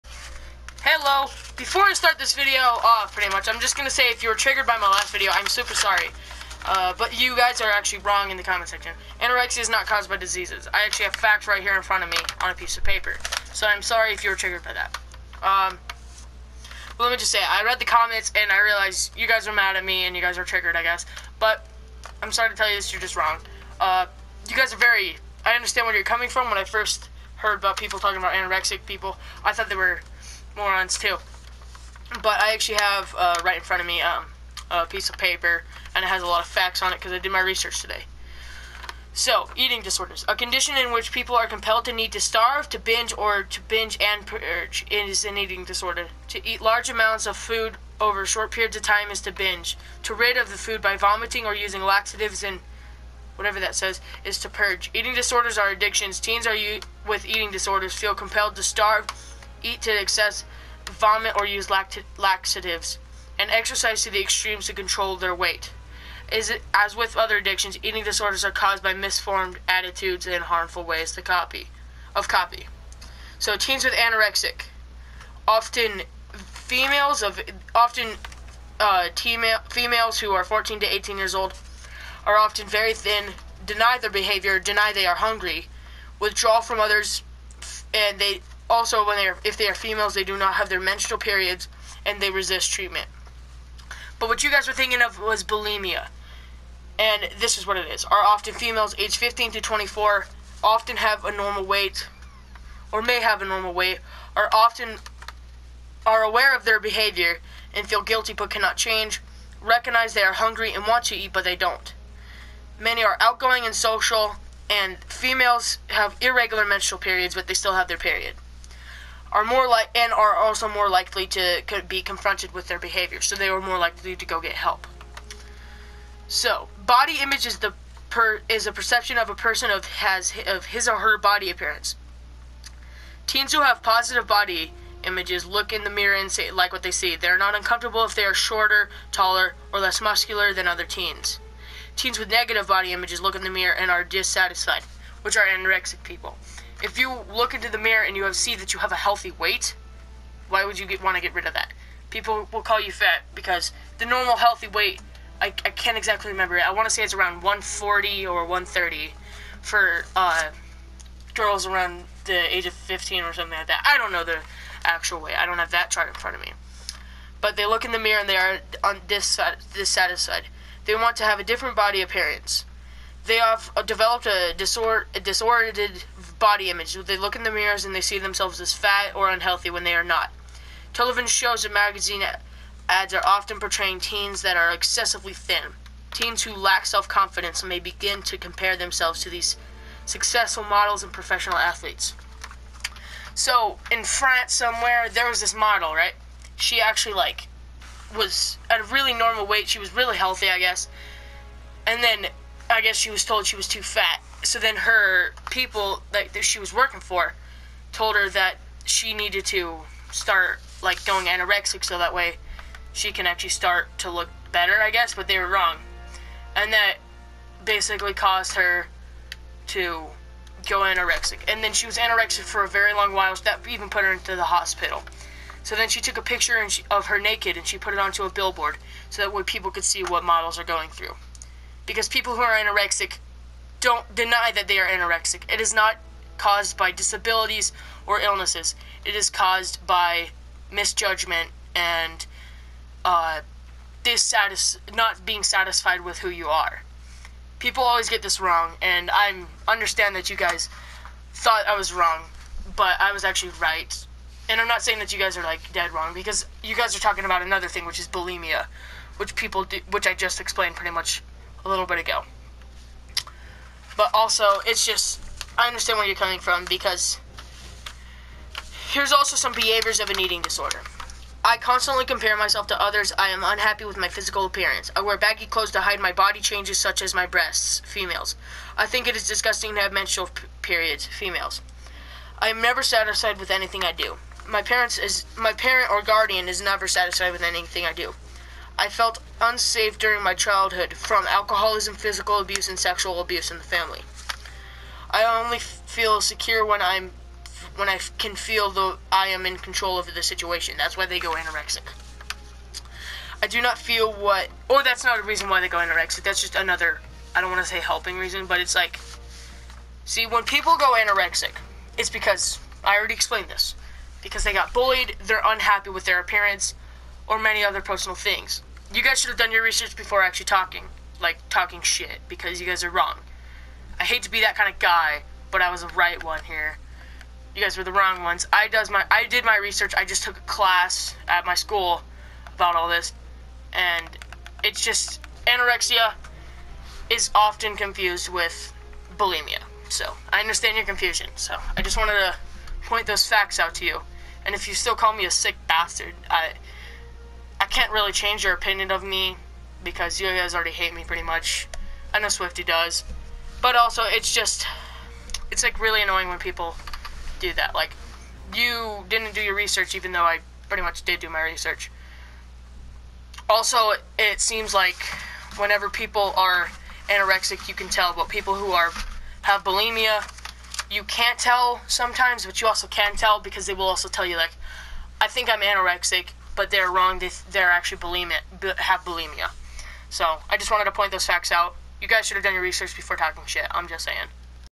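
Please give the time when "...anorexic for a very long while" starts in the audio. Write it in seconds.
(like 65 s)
221 s.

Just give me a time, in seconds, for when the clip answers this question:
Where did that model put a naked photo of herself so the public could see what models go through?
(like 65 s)
228 s.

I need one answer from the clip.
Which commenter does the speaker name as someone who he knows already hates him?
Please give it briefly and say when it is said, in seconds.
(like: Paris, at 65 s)
Swifty, at 352 s.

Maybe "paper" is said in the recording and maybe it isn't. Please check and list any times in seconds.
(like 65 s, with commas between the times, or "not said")
12 s, 35 s.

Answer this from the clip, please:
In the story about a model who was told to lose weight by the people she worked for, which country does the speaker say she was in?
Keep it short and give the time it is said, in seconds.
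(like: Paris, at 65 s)
France, at 194 s.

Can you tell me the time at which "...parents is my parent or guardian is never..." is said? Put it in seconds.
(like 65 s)
284 s.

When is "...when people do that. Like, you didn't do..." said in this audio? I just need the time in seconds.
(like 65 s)
356 s.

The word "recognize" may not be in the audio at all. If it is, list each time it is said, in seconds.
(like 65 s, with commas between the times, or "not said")
109 s.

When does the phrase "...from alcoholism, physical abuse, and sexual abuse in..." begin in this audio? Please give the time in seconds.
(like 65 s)
290 s.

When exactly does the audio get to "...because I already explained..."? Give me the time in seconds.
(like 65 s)
312 s.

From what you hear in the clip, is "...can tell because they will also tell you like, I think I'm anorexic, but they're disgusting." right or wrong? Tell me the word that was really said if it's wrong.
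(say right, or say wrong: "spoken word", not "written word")
wrong: "wrong", not "disgusting".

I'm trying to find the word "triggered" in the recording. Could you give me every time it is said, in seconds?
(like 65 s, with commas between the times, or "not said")
4 s, 14 s, 20 s.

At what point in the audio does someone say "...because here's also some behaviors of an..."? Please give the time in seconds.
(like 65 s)
266 s.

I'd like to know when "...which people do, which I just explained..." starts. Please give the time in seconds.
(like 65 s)
259 s.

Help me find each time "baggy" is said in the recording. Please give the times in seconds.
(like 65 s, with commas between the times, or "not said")
275 s.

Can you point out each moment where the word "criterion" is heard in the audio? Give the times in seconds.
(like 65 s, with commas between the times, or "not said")
not said.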